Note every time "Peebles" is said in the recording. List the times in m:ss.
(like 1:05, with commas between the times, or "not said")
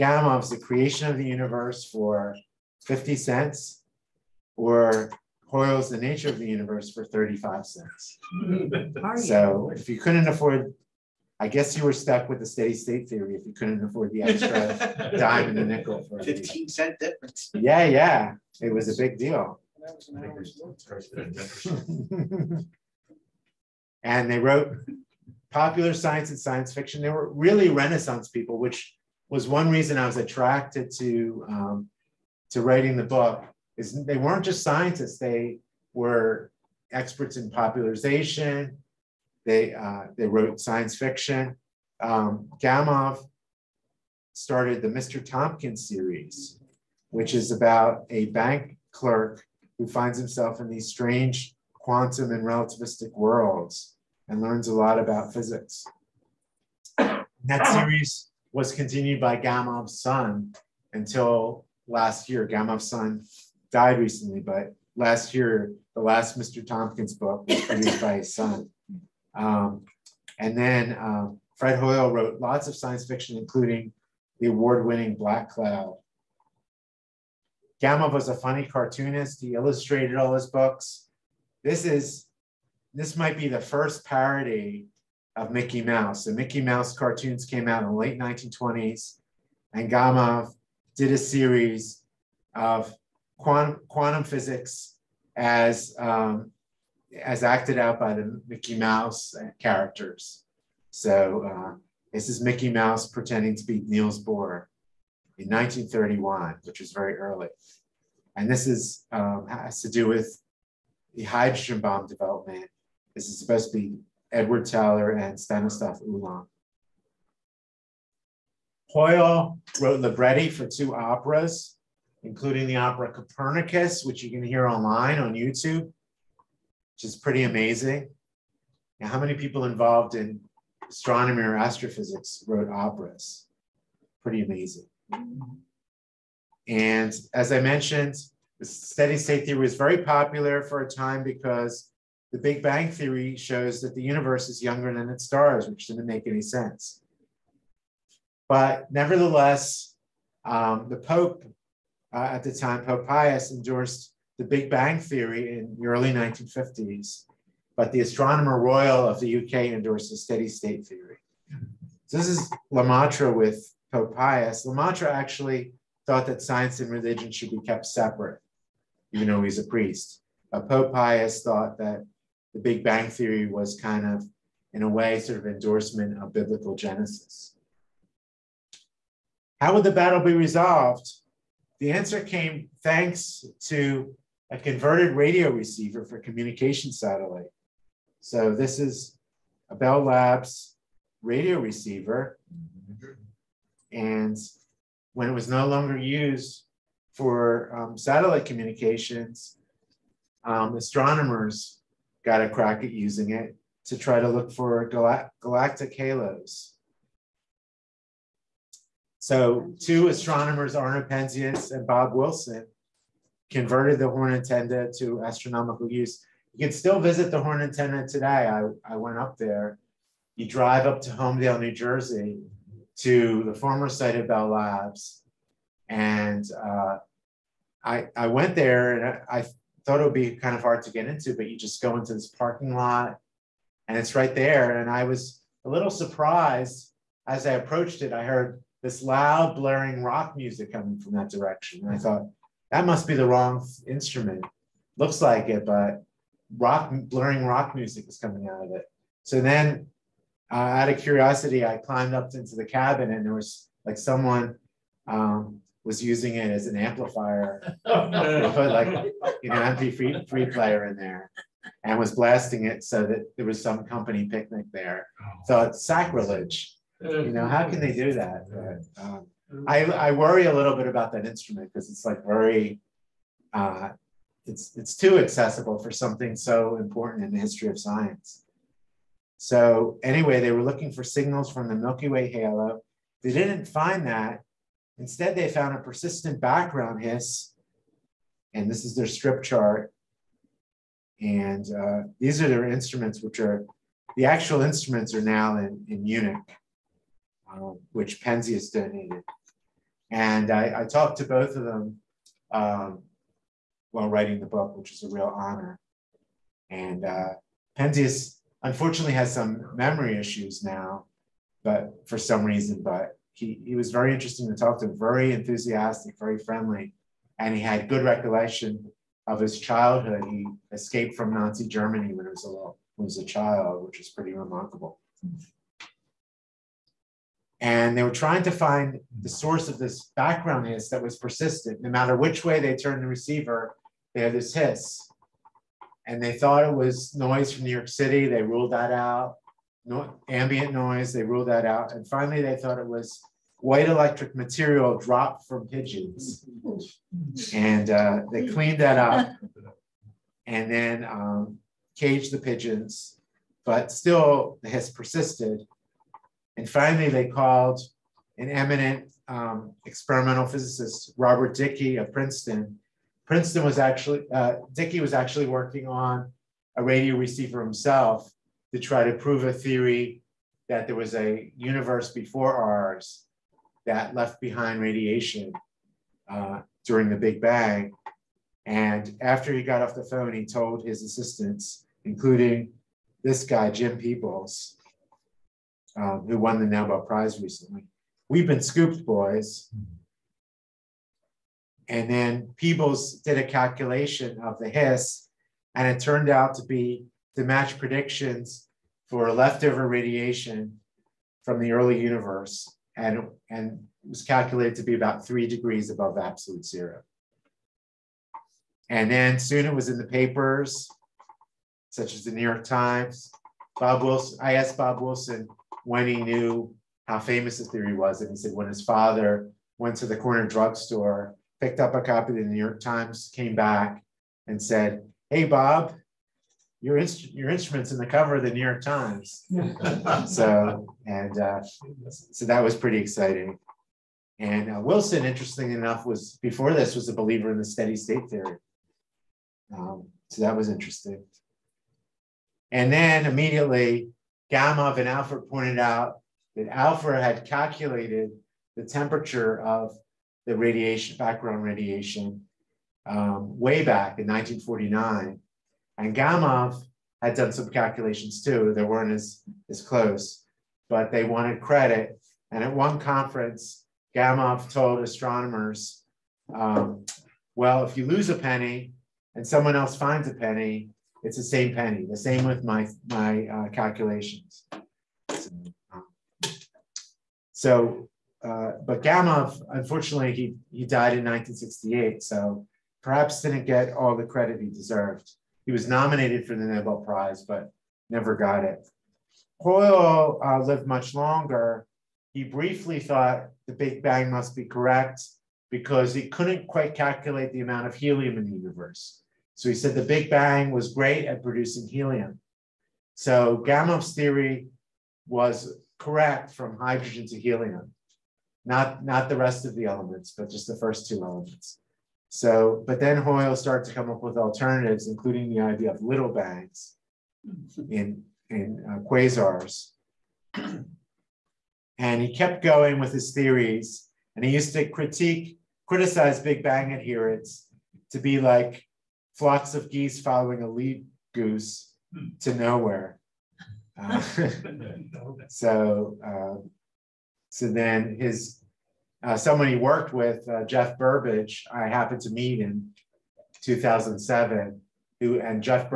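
6:23, 6:32.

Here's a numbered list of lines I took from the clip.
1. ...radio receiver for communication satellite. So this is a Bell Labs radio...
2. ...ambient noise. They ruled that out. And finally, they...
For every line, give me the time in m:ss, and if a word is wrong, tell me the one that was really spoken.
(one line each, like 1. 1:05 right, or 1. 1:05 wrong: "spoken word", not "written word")
1. 3:05 right
2. 5:40 right.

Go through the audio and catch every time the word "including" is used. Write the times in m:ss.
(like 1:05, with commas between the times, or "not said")
1:13, 2:02, 6:22, 8:35.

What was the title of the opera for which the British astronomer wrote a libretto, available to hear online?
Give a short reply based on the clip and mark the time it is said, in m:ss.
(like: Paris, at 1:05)
Copernicus, at 2:03.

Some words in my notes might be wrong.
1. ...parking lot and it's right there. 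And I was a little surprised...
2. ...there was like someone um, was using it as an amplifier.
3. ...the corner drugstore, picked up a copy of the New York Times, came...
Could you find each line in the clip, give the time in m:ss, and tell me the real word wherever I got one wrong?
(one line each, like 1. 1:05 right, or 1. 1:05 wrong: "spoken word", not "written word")
1. 3:52 right
2. 4:13 right
3. 7:00 right.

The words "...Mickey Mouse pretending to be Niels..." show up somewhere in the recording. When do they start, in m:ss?
1:42.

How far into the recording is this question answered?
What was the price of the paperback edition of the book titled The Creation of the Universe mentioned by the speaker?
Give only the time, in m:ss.
0:02.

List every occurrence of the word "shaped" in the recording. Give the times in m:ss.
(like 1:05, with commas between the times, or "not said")
not said.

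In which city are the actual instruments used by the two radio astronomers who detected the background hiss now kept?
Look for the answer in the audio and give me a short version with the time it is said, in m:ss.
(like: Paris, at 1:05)
Munich, at 4:56.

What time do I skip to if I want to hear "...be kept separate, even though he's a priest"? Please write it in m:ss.
2:47.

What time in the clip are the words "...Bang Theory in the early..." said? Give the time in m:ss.
2:34.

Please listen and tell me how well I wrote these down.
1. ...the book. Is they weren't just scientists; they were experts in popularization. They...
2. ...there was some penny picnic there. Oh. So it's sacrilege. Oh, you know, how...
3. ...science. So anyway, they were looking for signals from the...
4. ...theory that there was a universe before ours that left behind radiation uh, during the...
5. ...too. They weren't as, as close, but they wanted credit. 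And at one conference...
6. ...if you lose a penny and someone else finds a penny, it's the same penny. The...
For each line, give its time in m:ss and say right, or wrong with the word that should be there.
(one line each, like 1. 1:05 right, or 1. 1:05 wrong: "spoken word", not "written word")
1. 0:32 right
2. 4:23 wrong: "company", not "penny"
3. 4:37 right
4. 6:09 right
5. 7:38 right
6. 7:47 right.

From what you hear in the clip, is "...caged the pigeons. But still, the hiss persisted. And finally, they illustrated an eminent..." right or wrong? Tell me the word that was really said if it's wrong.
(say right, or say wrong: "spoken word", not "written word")
wrong: "called", not "illustrated".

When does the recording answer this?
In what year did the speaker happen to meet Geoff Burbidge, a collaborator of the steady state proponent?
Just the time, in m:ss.
9:03.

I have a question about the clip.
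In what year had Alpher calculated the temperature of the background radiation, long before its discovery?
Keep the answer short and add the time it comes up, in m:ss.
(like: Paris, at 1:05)
1949, at 7:34.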